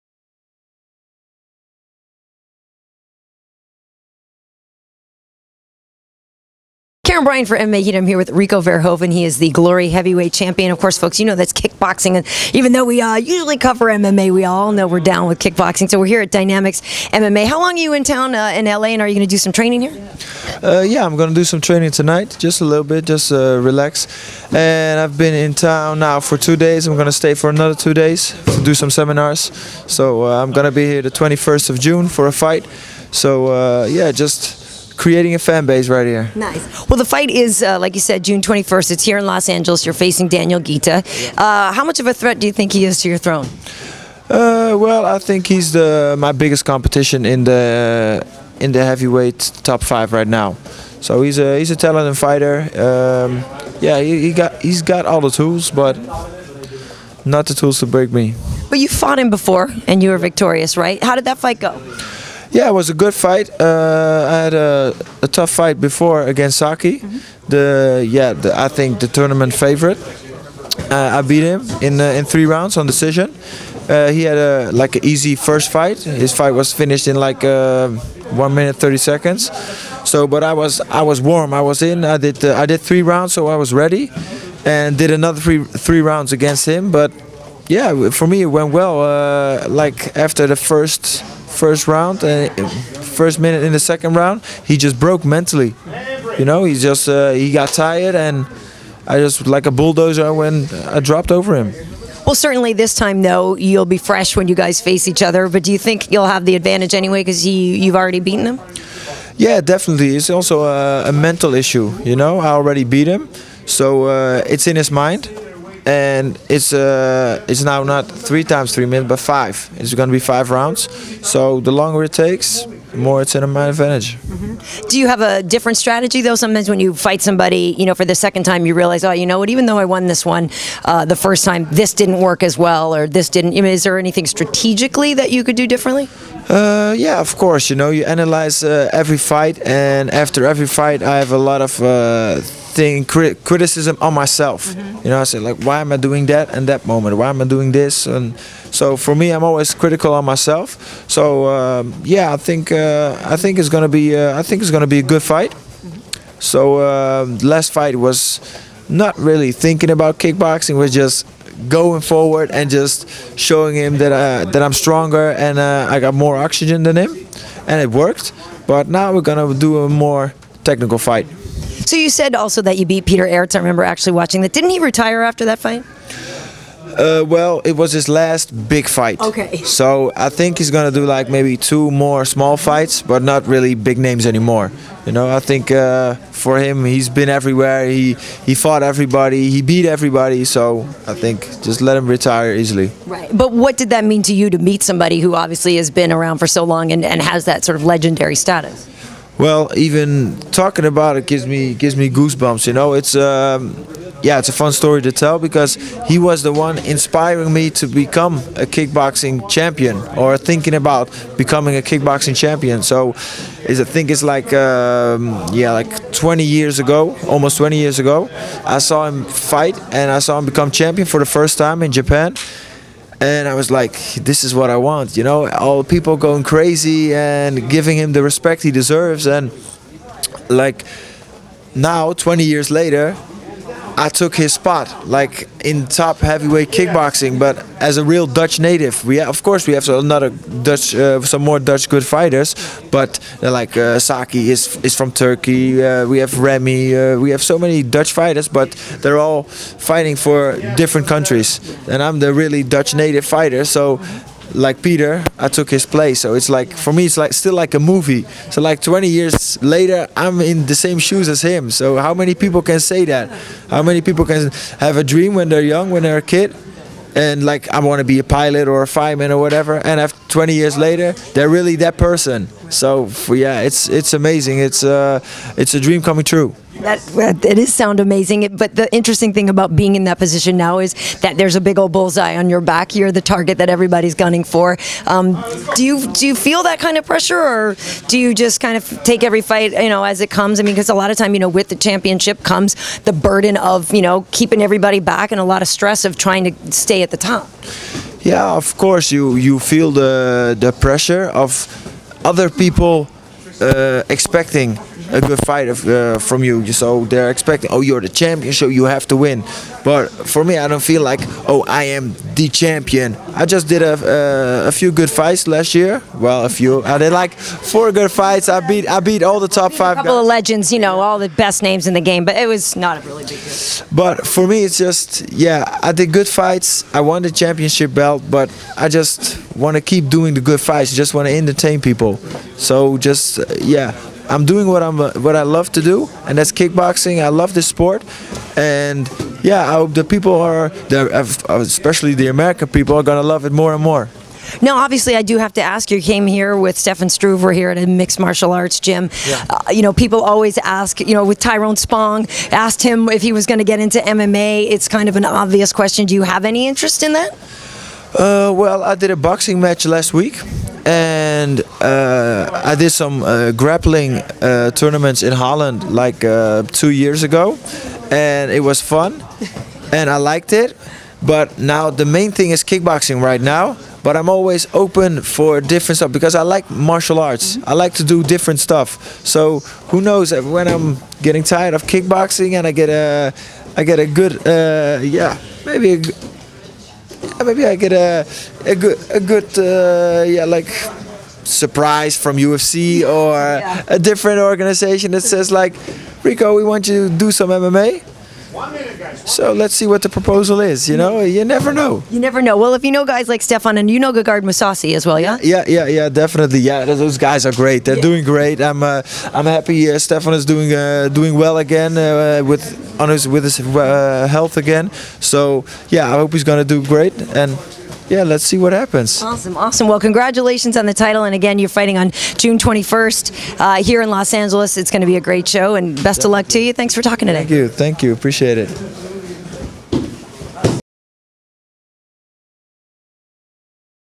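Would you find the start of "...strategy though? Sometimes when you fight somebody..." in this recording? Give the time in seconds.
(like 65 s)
125 s.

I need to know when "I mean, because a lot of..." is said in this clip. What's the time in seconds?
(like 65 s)
290 s.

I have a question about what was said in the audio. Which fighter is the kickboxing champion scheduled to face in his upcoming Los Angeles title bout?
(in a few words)
Daniel Ghita.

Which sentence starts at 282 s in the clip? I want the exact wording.
You're the target that everybody's gunning for.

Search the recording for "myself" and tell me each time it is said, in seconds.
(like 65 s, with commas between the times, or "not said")
144 s, 150 s.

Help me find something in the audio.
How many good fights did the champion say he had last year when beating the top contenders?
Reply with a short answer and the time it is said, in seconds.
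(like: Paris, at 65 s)
4, at 317 s.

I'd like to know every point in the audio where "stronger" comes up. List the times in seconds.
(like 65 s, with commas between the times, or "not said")
164 s.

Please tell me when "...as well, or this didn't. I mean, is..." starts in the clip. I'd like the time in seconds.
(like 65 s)
132 s.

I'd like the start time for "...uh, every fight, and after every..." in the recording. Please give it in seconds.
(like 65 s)
138 s.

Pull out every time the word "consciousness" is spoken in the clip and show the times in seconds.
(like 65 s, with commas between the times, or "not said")
not said.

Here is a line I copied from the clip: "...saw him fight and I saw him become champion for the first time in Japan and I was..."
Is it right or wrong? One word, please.
right.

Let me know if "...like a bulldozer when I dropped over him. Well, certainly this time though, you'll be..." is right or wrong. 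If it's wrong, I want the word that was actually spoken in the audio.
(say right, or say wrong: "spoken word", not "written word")
right.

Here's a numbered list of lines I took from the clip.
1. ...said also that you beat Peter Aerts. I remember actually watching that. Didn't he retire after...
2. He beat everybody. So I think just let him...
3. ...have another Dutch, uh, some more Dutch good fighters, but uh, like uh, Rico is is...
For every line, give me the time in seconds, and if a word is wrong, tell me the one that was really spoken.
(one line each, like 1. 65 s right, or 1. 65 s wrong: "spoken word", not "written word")
1. 172 s right
2. 189 s right
3. 239 s wrong: "Saki", not "Rico".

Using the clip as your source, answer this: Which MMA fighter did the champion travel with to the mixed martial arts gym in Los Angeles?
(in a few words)
Stefan Struve.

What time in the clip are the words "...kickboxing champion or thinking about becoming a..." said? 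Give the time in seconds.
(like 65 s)
208 s.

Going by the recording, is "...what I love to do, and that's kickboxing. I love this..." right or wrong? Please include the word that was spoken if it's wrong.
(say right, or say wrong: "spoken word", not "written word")
right.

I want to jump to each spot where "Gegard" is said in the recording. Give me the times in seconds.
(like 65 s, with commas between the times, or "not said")
404 s.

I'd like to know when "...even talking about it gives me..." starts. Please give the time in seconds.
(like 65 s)
199 s.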